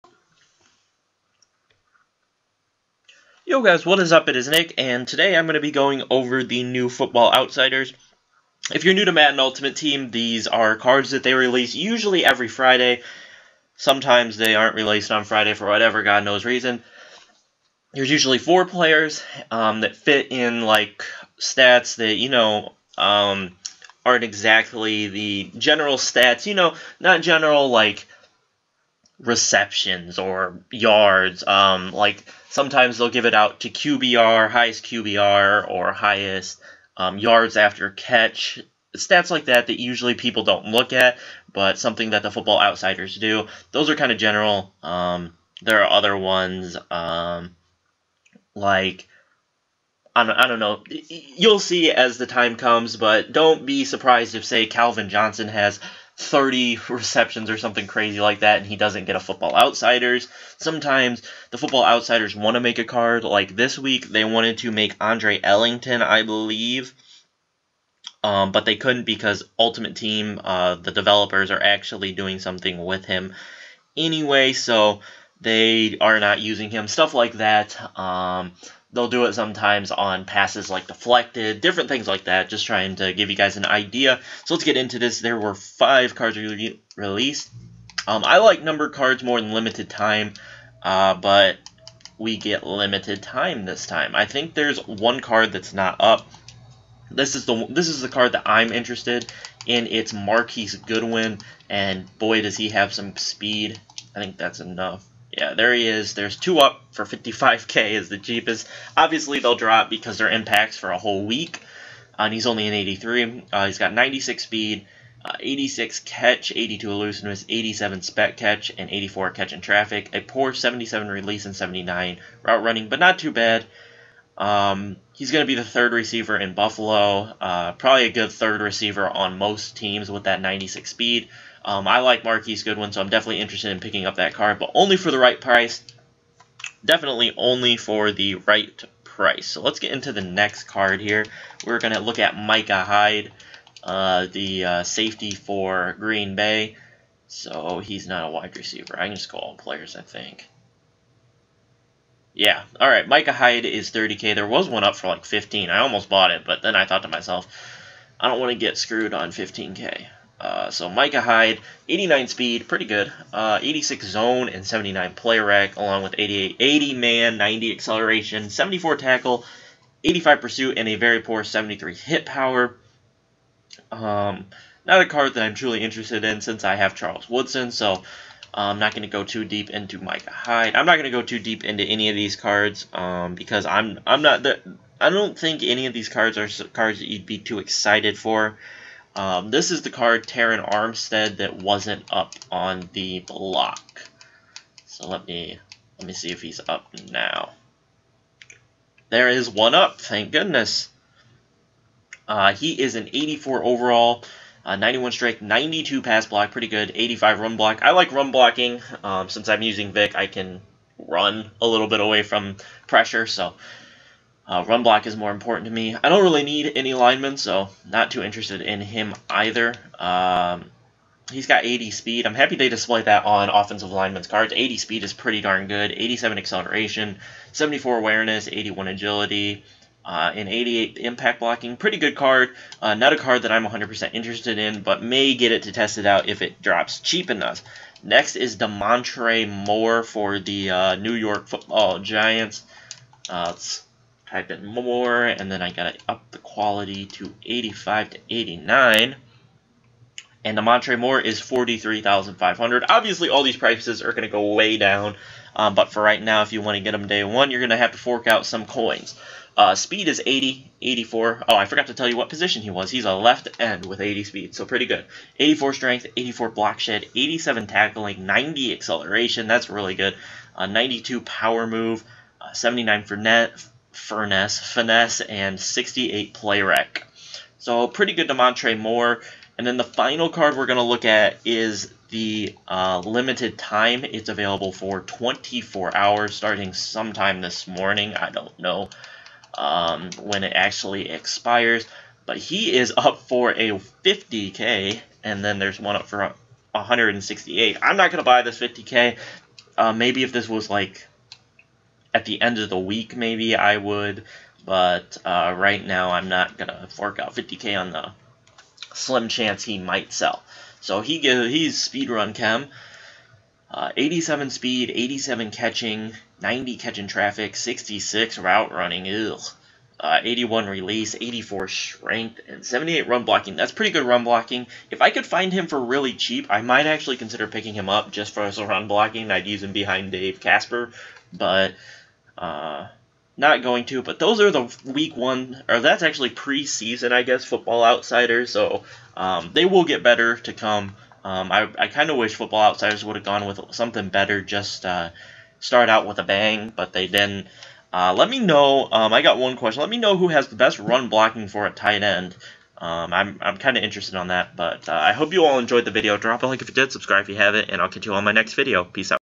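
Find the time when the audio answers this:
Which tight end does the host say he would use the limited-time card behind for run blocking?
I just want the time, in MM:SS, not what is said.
05:30.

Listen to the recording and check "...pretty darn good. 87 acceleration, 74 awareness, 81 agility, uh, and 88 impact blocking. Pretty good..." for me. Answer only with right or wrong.
right.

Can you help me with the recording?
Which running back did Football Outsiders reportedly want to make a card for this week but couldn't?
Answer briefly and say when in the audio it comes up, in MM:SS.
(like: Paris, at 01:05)
Andre Ellington, at 01:05.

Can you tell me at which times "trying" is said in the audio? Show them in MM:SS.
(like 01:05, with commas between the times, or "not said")
01:22.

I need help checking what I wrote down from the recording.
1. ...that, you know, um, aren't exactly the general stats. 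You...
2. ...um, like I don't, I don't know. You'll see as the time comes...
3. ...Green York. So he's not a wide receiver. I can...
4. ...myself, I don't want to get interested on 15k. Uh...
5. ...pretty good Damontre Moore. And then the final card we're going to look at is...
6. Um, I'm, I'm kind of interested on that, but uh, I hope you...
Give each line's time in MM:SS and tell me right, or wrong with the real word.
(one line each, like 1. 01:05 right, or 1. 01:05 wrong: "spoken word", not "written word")
1. 00:21 right
2. 00:46 right
3. 02:25 wrong: "Bay", not "York"
4. 02:37 wrong: "screwed", not "interested"
5. 04:37 right
6. 05:52 right.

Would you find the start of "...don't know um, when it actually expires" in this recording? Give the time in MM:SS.
04:48.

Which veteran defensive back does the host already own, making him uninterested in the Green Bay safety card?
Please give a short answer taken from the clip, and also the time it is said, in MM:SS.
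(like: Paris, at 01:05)
Charles Woodson, at 02:56.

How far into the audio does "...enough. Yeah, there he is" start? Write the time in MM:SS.
01:44.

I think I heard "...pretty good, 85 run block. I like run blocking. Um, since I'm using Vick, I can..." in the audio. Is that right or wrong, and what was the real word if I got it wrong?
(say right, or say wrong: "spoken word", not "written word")
right.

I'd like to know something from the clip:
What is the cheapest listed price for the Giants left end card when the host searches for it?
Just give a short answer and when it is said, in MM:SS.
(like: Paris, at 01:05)
43500, at 04:11.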